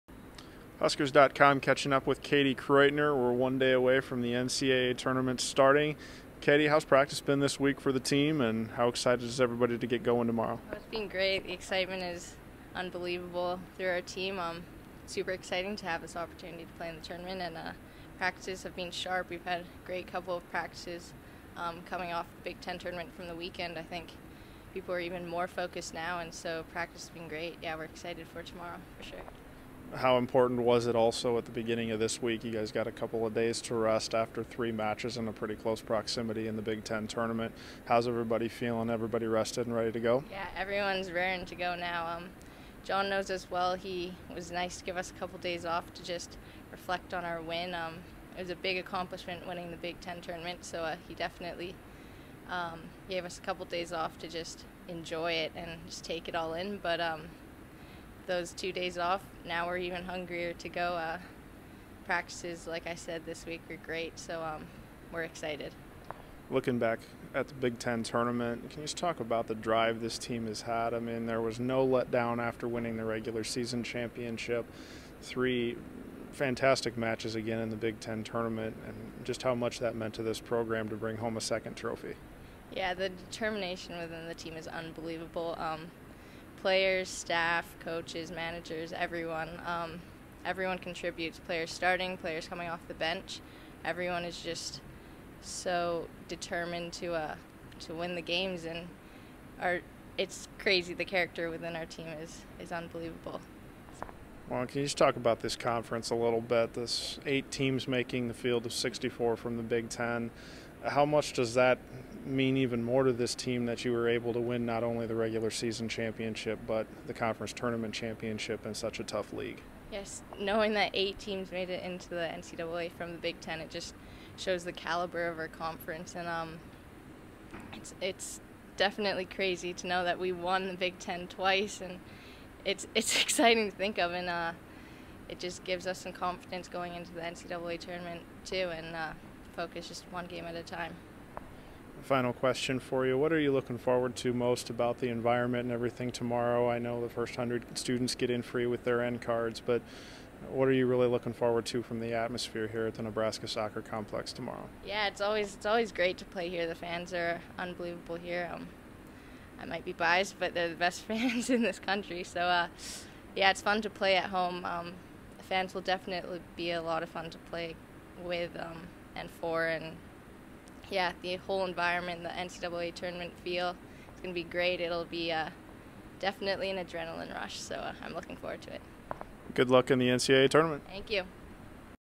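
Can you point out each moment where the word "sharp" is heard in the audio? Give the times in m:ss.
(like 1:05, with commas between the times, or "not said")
0:18.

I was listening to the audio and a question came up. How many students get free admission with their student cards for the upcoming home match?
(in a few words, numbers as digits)
100.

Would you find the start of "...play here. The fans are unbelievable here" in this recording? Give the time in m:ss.
2:36.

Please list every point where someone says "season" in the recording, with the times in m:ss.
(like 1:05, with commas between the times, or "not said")
1:13, 1:55.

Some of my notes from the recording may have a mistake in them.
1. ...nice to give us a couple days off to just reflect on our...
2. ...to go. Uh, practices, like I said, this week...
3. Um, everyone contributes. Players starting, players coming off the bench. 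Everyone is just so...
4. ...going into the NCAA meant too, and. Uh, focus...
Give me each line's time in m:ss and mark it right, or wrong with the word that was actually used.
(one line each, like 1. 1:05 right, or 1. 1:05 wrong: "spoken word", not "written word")
1. 0:44 right
2. 1:00 right
3. 1:29 right
4. 2:16 wrong: "tournament", not "meant".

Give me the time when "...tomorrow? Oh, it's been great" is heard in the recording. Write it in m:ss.
0:10.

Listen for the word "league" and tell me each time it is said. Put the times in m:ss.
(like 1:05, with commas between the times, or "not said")
1:59.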